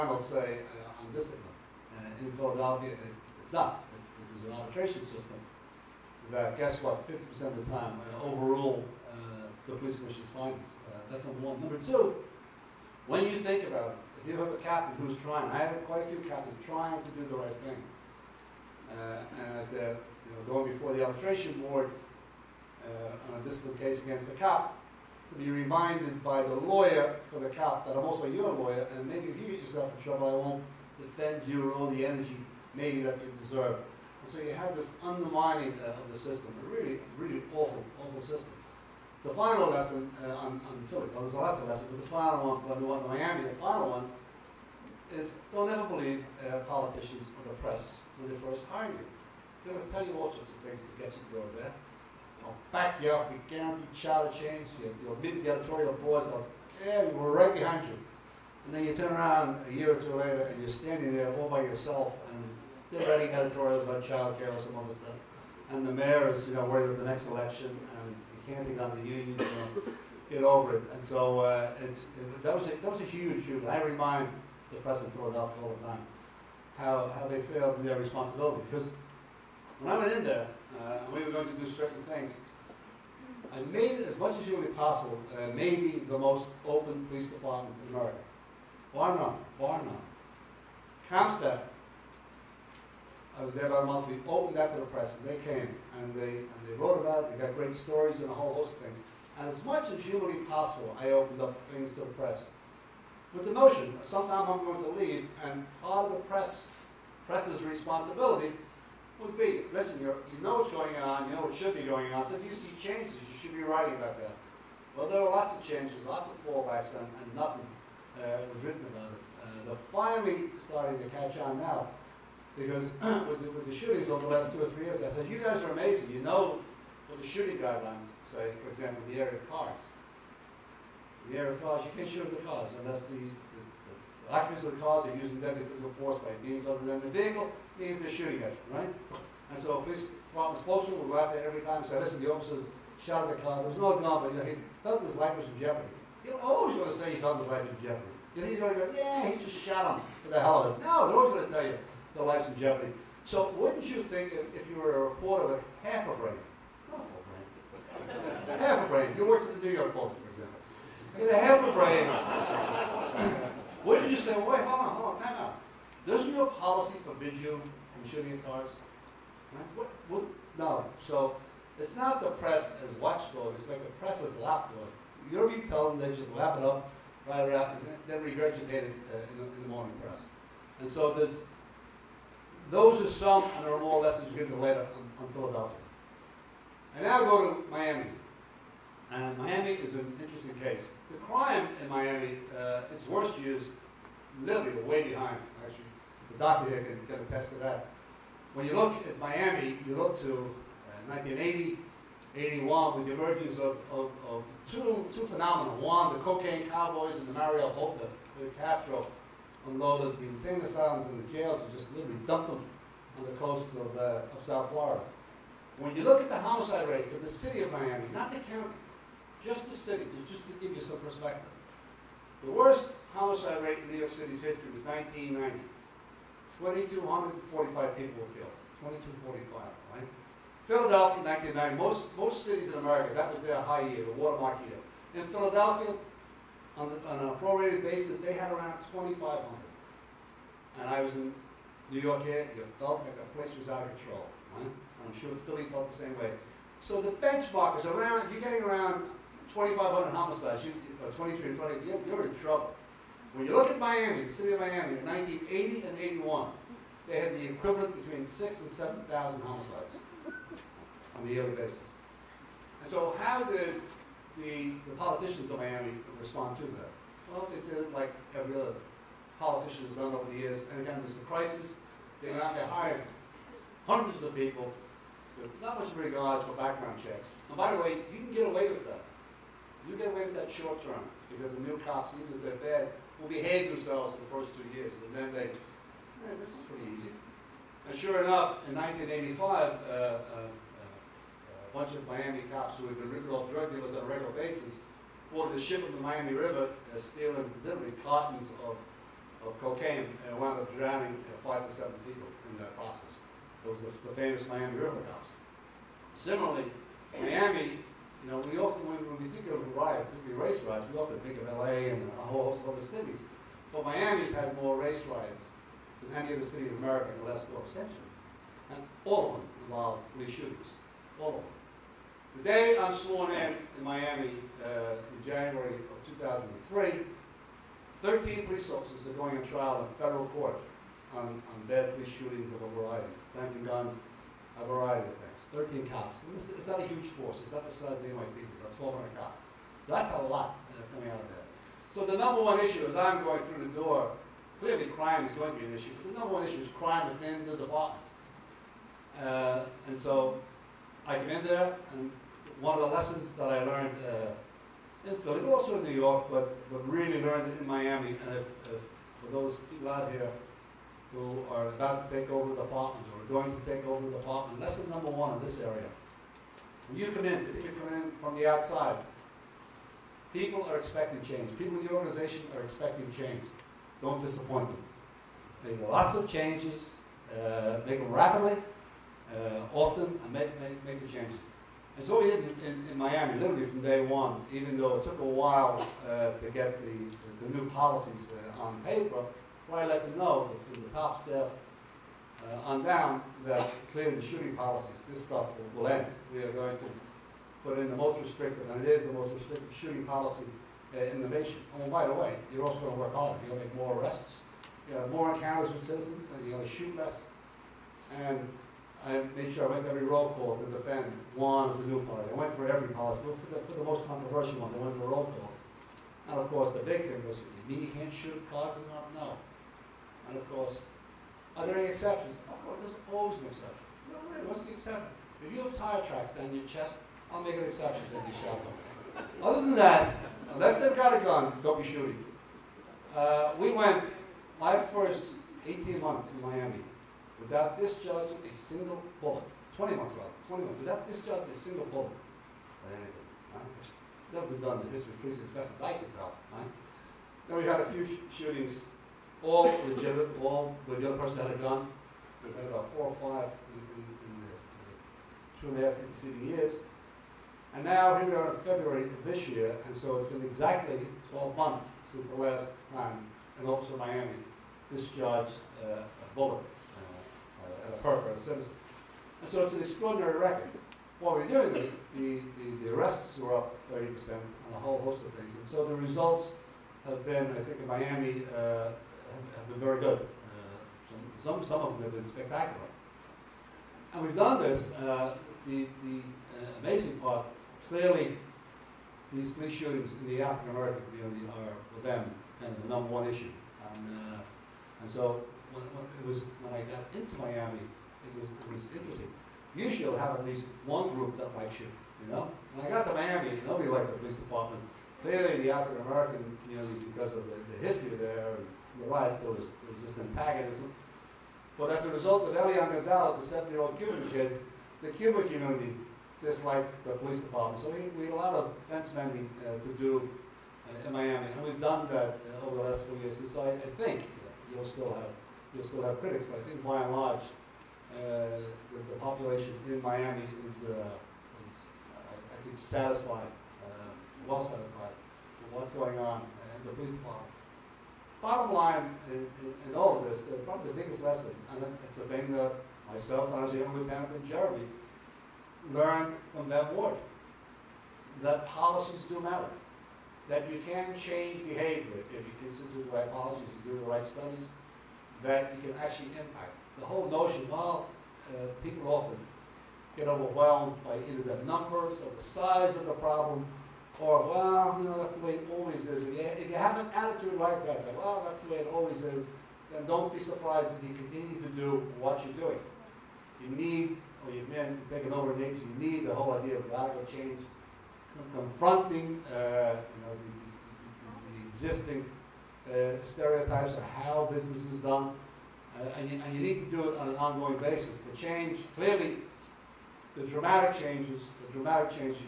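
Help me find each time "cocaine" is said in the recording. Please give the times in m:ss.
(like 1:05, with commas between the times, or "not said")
3:26, 4:59.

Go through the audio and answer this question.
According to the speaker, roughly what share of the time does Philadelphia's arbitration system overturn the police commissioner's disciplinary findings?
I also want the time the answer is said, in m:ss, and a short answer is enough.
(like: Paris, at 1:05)
50%, at 0:07.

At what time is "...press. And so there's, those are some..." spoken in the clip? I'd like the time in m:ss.
3:00.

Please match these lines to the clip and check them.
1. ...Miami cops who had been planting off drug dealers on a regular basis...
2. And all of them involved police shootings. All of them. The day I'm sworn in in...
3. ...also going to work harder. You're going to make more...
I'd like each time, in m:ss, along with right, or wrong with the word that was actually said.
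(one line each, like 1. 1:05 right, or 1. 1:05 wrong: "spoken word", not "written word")
1. 4:52 wrong: "ripping", not "planting"
2. 5:18 right
3. 6:42 right.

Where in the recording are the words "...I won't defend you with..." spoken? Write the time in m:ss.
0:30.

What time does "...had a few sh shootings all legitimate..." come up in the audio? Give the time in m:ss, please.
7:27.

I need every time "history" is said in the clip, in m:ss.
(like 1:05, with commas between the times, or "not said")
3:44, 7:24, 8:27.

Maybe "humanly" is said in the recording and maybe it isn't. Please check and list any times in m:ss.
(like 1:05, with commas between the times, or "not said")
1:24, 1:39.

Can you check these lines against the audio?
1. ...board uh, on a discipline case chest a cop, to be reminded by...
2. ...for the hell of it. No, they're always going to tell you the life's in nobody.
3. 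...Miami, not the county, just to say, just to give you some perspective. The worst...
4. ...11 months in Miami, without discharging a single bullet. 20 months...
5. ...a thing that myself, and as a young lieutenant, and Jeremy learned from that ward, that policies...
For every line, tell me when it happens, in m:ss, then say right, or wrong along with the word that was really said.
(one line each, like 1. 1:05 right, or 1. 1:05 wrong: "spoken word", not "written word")
1. 0:21 wrong: "against", not "chest"
2. 2:30 wrong: "jeopardy", not "nobody"
3. 3:37 right
4. 7:15 wrong: "18", not "11"
5. 9:02 right.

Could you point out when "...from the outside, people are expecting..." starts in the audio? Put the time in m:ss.
6:08.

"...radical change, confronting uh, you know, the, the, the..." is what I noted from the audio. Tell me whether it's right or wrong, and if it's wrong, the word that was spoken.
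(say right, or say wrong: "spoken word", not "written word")
right.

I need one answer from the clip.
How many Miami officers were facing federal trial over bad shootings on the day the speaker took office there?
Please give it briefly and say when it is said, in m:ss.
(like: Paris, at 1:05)
13, at 5:28.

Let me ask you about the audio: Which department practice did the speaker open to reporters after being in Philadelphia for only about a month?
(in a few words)
CompStat.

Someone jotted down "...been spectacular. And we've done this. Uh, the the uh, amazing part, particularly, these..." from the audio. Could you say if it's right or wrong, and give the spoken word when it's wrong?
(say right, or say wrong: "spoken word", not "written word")
wrong: "clearly", not "particularly".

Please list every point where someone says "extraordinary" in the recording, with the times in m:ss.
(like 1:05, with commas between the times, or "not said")
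7:49.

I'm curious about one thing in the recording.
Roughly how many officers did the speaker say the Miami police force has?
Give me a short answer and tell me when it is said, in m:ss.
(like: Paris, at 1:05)
1,200, at 5:38.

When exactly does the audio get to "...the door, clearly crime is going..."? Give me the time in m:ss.
5:43.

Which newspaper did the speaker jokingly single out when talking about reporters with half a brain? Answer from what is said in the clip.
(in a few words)
New York Post.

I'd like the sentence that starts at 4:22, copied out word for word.
And so how did the, the politicians of Miami respond to that?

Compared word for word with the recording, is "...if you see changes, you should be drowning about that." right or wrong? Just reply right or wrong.
wrong.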